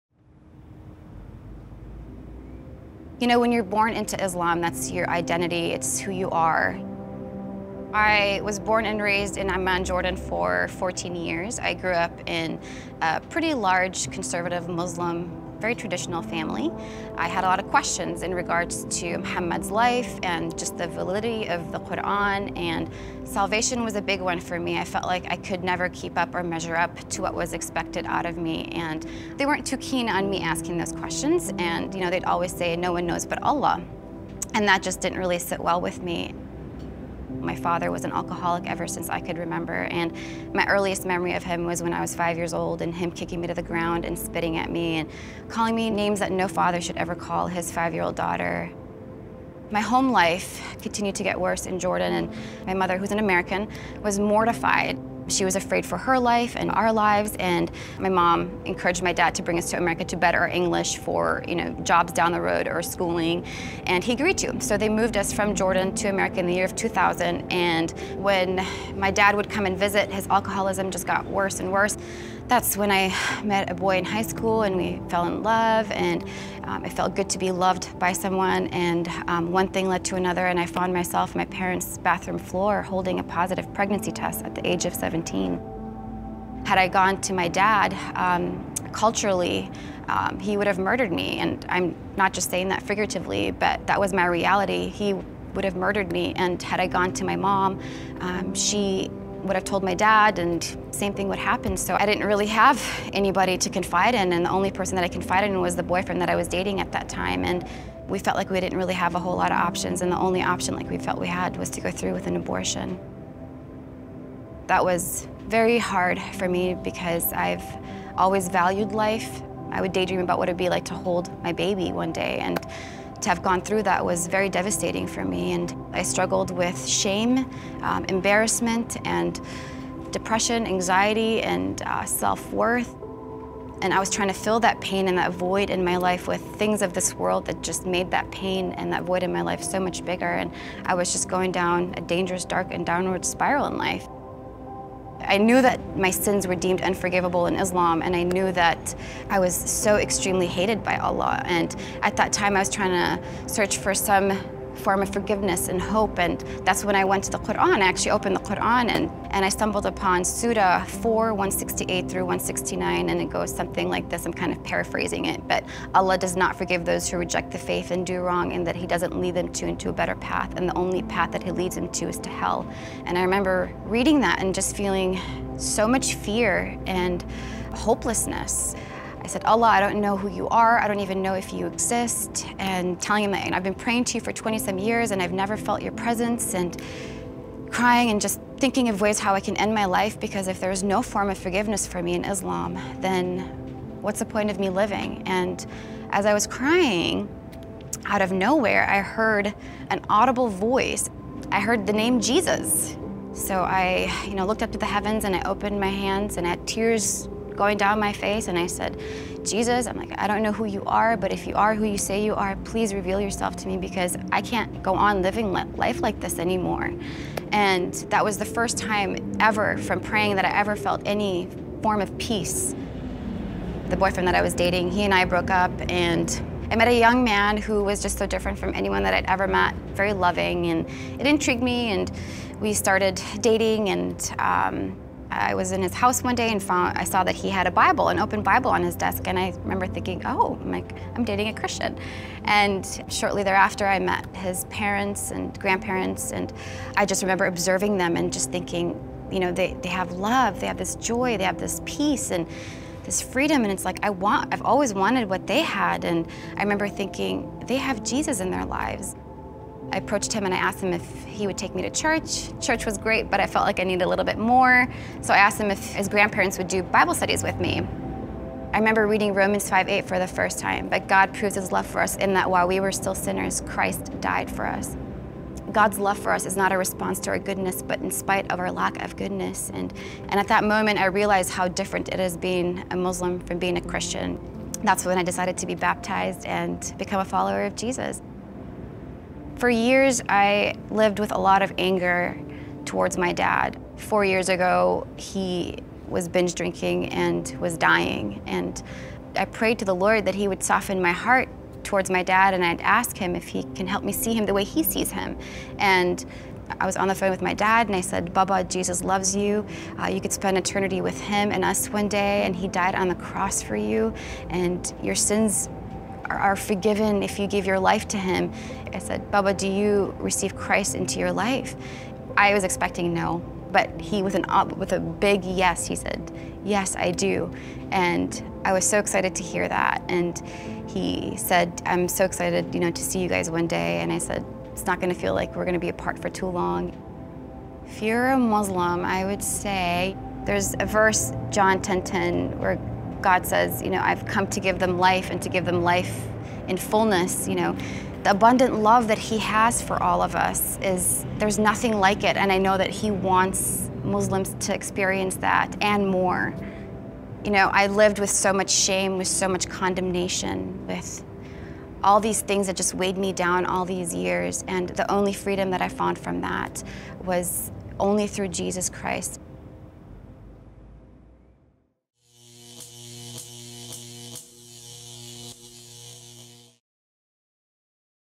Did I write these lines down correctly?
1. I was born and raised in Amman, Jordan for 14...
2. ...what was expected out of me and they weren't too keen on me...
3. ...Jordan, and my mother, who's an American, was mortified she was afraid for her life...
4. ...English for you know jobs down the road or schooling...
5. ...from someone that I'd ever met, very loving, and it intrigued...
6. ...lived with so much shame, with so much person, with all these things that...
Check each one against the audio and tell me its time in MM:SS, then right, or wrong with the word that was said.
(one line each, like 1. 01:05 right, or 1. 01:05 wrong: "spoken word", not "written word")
1. 00:07 right
2. 00:27 right
3. 00:51 right
4. 01:00 right
5. 03:48 wrong: "anyone", not "someone"
6. 05:57 wrong: "condemnation", not "person".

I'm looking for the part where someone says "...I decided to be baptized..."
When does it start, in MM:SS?
04:45.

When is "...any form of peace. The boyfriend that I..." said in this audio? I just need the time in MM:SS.
03:41.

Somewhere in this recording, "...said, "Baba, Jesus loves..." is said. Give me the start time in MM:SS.
05:08.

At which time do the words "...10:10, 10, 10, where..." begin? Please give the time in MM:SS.
05:41.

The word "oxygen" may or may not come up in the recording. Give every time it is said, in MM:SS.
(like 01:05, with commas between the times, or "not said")
not said.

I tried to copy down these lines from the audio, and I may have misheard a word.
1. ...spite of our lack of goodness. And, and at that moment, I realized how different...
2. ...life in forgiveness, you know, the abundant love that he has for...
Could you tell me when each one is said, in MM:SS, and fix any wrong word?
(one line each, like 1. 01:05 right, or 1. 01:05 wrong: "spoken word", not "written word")
1. 04:38 right
2. 05:45 wrong: "fullness", not "forgiveness".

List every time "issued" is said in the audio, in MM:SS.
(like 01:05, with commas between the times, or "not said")
not said.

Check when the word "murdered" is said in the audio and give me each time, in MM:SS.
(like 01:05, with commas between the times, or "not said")
01:30, 01:35.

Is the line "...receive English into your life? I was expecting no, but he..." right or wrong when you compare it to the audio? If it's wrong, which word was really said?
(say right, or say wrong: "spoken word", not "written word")
wrong: "Christ", not "English".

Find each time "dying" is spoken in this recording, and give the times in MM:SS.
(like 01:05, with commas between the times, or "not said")
04:57.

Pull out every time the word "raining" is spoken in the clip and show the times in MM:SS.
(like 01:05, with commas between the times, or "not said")
not said.